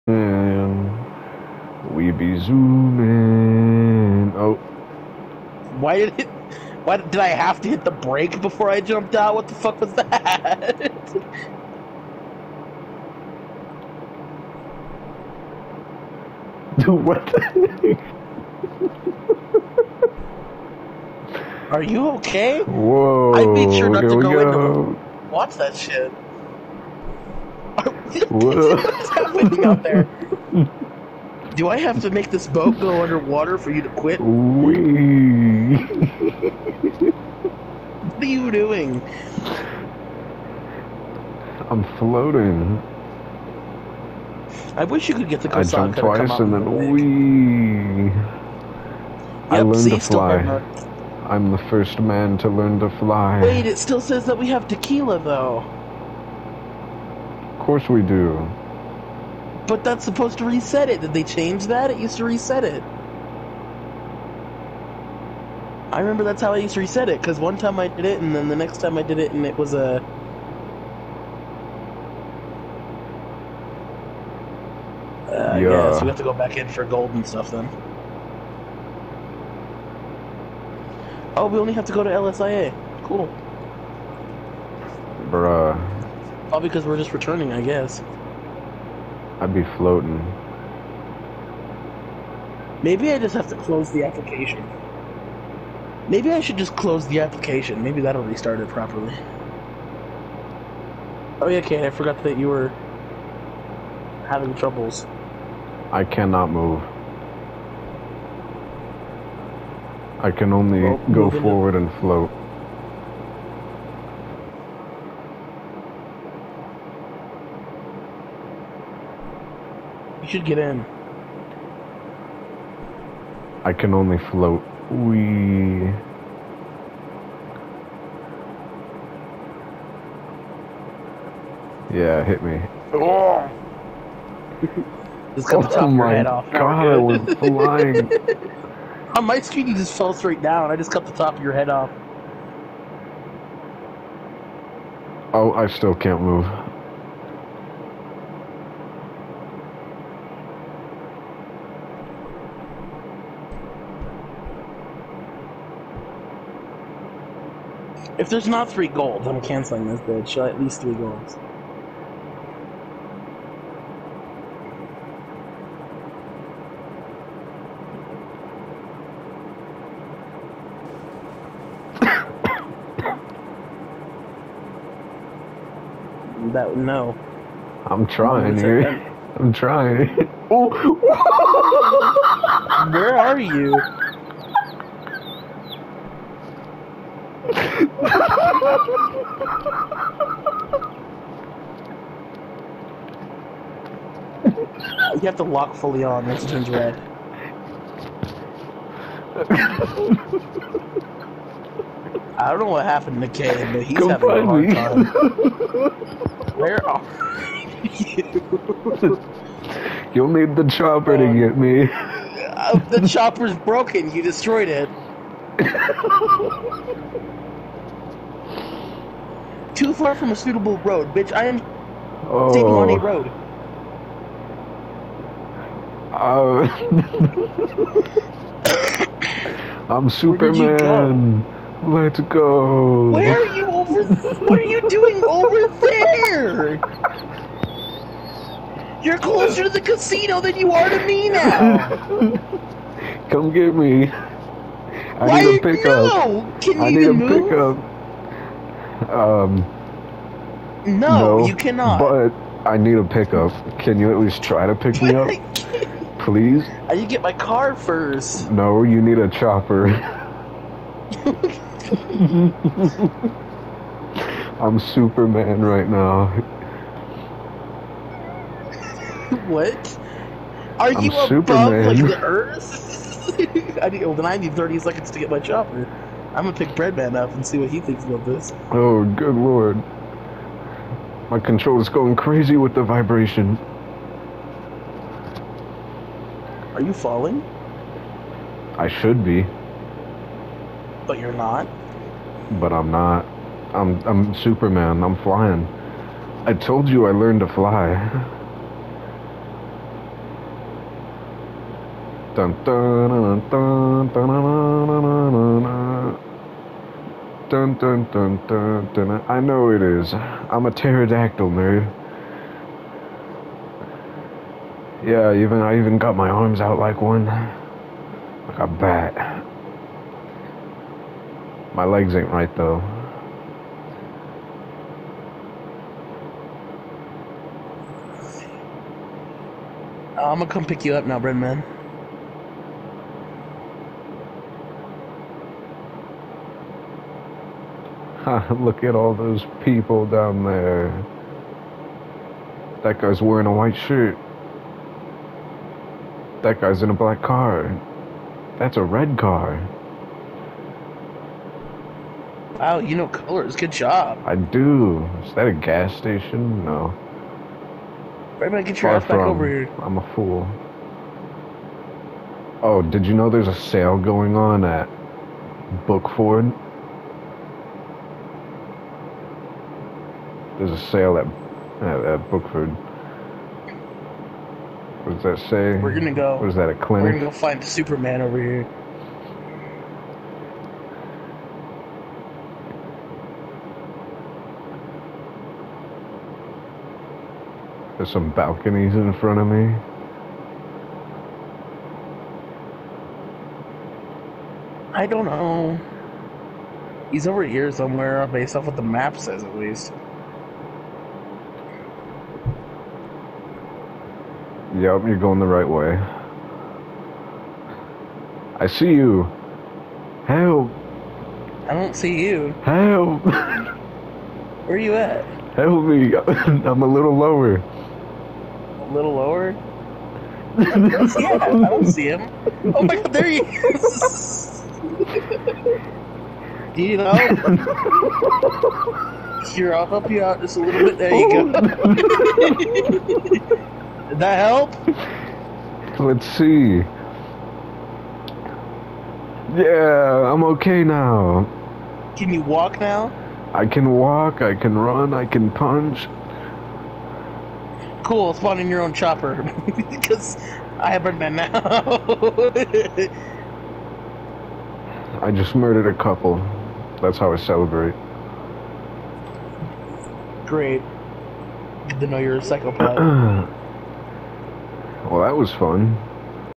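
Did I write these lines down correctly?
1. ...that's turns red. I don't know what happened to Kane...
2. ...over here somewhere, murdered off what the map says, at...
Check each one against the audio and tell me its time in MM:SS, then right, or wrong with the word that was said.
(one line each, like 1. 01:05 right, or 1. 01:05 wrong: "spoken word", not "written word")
1. 03:16 right
2. 06:37 wrong: "based", not "murdered".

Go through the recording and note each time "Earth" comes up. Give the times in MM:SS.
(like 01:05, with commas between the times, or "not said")
04:32.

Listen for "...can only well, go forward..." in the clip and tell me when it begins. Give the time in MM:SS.
01:50.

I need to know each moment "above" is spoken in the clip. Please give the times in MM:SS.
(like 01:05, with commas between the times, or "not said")
04:31.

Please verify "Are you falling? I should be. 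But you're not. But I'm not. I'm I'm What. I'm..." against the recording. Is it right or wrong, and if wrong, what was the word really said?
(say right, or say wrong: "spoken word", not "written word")
wrong: "Superman", not "What".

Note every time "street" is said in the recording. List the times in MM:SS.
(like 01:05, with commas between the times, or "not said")
not said.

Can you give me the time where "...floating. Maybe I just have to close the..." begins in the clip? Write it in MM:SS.
01:29.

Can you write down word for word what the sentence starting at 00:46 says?
I jumped twice and then wee.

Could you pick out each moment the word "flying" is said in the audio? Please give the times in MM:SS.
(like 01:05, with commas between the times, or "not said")
02:17, 04:55.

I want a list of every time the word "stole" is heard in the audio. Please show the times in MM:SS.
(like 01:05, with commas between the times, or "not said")
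not said.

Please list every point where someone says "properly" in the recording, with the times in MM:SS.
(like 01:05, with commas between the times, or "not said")
01:38.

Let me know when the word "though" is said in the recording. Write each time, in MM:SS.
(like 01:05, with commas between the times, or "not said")
00:55, 05:22.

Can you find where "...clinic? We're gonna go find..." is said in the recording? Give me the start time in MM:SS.
06:16.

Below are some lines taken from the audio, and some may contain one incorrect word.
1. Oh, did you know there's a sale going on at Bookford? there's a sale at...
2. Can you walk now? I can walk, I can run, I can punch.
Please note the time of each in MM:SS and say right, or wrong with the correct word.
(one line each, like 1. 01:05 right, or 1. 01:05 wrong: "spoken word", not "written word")
1. 06:02 right
2. 07:22 right.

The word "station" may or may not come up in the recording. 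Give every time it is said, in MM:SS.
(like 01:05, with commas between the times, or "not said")
05:55.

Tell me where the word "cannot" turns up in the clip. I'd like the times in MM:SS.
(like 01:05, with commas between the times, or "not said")
01:46, 04:11.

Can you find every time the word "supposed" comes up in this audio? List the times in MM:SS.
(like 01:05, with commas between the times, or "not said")
01:00.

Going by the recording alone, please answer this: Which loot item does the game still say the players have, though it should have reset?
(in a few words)
Tequila.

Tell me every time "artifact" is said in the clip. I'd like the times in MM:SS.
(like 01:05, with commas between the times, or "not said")
not said.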